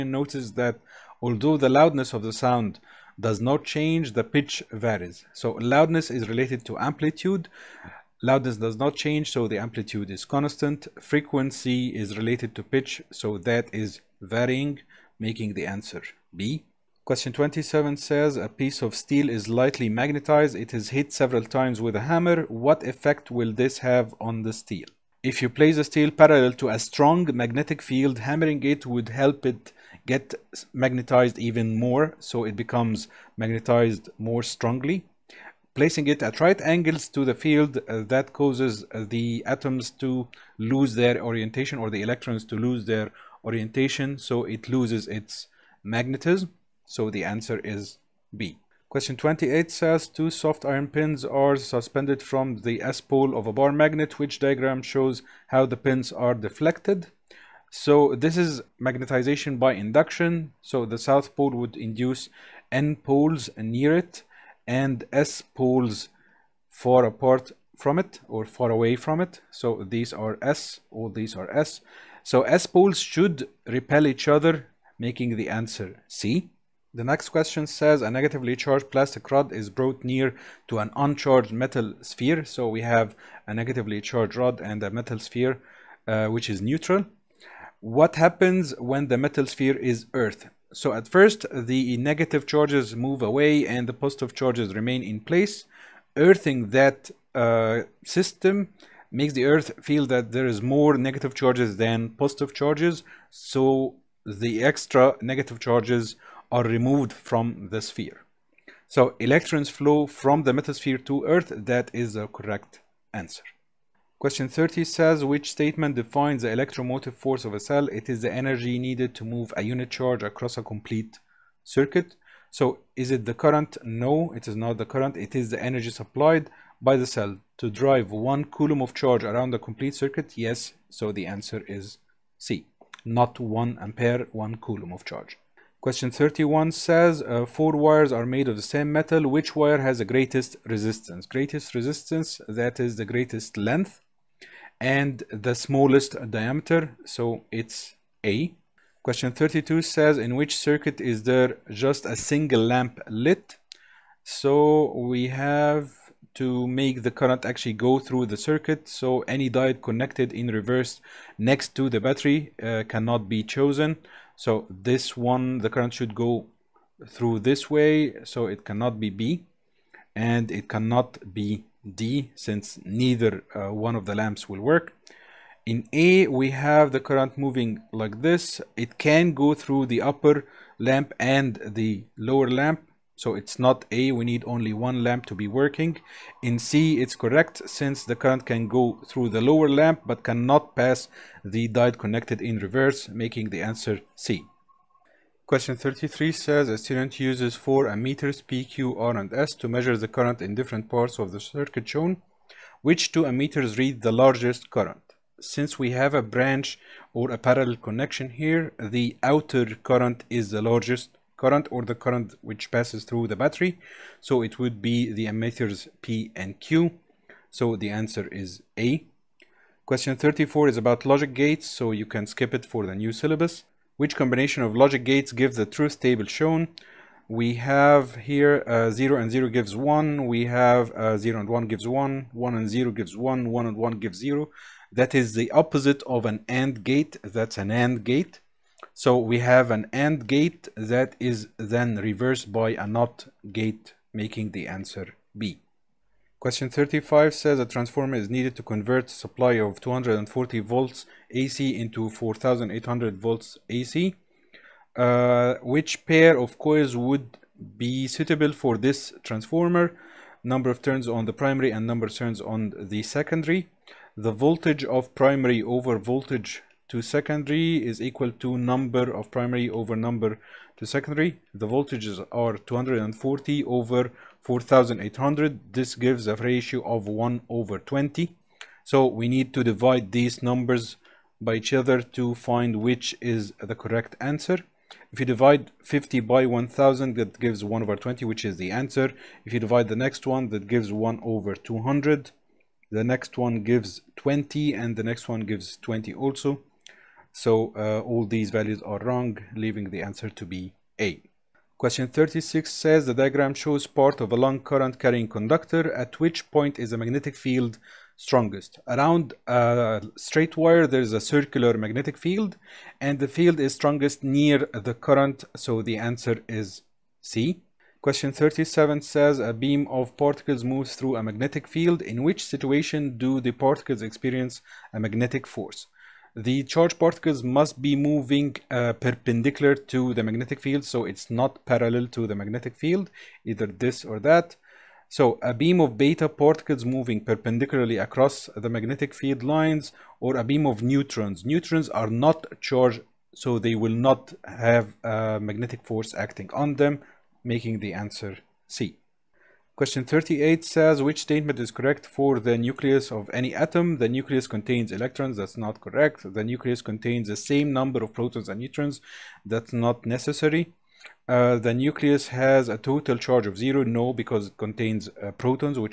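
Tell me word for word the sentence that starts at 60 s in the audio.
So the south pole would induce N poles near it and S poles far apart from it or far away from it.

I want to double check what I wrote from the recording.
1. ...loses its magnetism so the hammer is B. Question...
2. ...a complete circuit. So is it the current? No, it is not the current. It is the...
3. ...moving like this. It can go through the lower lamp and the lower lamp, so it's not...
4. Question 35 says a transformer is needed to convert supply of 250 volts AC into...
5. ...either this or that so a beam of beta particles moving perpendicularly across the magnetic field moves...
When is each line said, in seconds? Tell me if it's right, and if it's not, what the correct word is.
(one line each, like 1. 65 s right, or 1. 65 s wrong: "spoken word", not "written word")
1. 44 s wrong: "answer", not "hammer"
2. 120 s right
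3. 177 s wrong: "upper", not "lower"
4. 246 s wrong: "240", not "250"
5. 333 s wrong: "lines", not "moves".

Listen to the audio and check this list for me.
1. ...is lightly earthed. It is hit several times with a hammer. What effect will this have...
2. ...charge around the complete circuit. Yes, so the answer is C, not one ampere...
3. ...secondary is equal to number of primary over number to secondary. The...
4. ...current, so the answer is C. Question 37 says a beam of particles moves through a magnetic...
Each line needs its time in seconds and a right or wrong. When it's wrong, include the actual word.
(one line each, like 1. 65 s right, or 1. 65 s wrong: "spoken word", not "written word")
1. 19 s wrong: "magnetized", not "earthed"
2. 128 s right
3. 267 s right
4. 314 s right.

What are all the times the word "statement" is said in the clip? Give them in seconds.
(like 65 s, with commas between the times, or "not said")
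115 s, 351 s.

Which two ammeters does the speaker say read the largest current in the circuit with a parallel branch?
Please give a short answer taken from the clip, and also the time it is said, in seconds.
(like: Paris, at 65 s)
P and Q, at 216 s.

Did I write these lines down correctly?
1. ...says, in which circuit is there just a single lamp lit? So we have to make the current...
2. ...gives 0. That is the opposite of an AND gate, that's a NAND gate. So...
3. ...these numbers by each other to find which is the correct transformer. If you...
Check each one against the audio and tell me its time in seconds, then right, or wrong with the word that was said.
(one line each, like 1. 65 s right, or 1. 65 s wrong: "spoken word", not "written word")
1. 149 s right
2. 234 s right
3. 280 s wrong: "answer", not "transformer".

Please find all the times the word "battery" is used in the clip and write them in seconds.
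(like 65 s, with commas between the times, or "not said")
162 s, 213 s.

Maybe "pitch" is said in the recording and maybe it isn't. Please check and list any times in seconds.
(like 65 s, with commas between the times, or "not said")
4 s, 12 s.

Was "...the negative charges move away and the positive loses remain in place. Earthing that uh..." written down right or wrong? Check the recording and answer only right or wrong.
wrong.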